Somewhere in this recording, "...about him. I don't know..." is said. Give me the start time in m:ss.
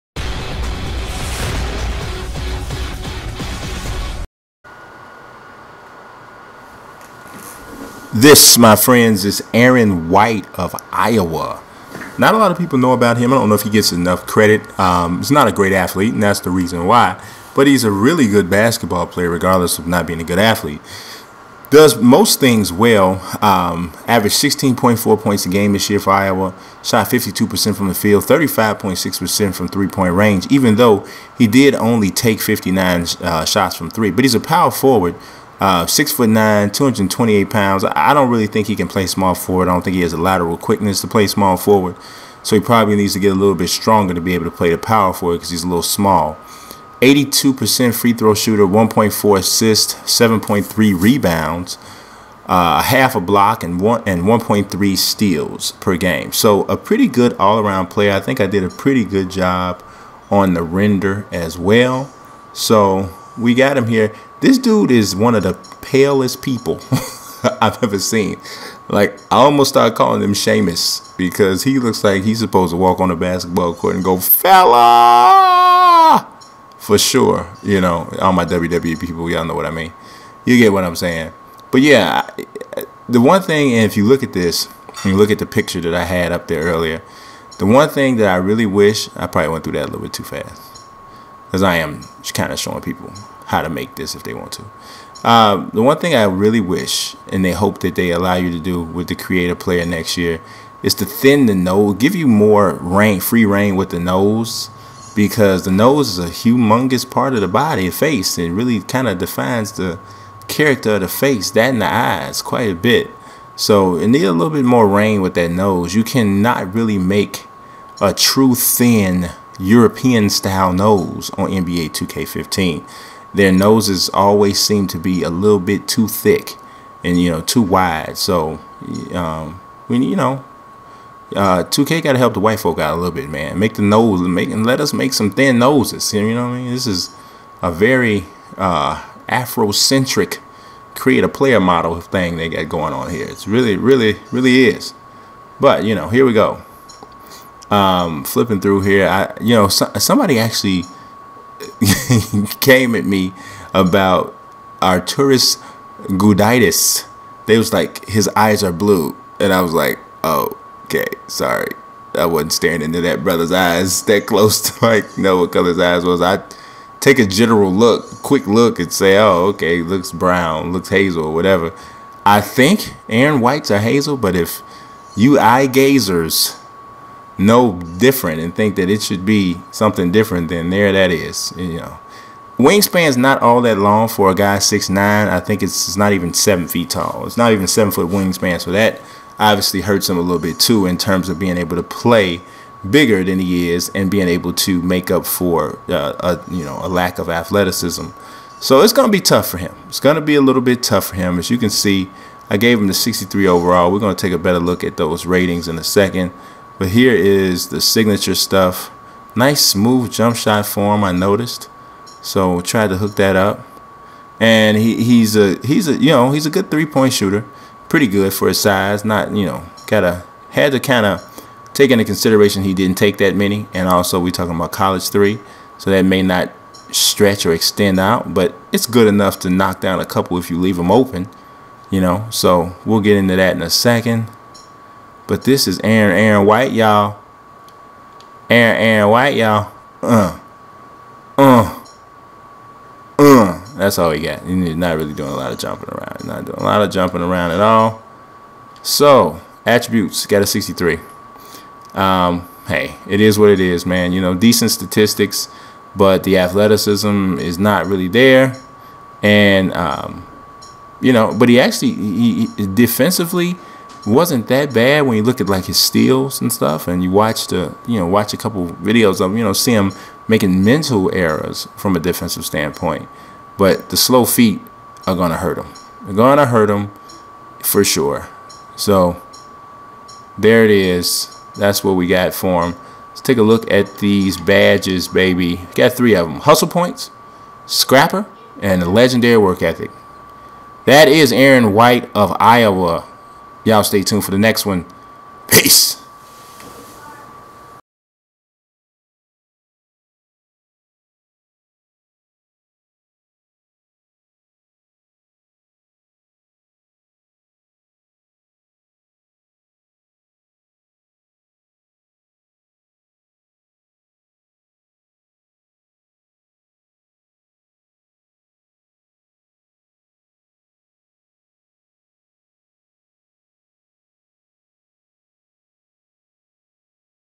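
0:12.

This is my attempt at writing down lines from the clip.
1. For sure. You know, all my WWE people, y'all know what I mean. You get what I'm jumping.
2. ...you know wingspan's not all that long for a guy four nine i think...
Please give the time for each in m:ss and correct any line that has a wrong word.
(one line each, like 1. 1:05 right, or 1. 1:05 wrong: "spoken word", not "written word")
1. 1:16 wrong: "saying", not "jumping"
2. 3:01 wrong: "six", not "four".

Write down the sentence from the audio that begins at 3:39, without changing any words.
Not, you know, gotta had to kinda take into consideration he didn't take that many.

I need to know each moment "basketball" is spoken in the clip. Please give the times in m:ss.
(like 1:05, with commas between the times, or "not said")
0:18, 1:13.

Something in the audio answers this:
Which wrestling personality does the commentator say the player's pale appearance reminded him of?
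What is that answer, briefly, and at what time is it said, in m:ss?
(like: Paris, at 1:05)
Sheamus, at 1:10.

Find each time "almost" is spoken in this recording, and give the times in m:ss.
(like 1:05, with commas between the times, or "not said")
1:09.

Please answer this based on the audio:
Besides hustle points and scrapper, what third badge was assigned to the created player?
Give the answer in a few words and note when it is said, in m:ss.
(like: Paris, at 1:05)
Legendary work ethic, at 4:48.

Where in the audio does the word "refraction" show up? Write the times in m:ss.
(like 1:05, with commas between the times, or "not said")
not said.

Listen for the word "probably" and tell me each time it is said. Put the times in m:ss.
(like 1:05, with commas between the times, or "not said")
0:42, 1:29.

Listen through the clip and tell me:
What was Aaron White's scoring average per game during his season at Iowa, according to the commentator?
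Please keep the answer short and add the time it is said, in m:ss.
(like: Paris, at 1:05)
16.4, at 0:24.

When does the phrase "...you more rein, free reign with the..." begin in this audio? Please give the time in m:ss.
1:42.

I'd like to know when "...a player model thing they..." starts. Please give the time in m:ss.
2:21.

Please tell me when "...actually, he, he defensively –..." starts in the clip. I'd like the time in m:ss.
4:21.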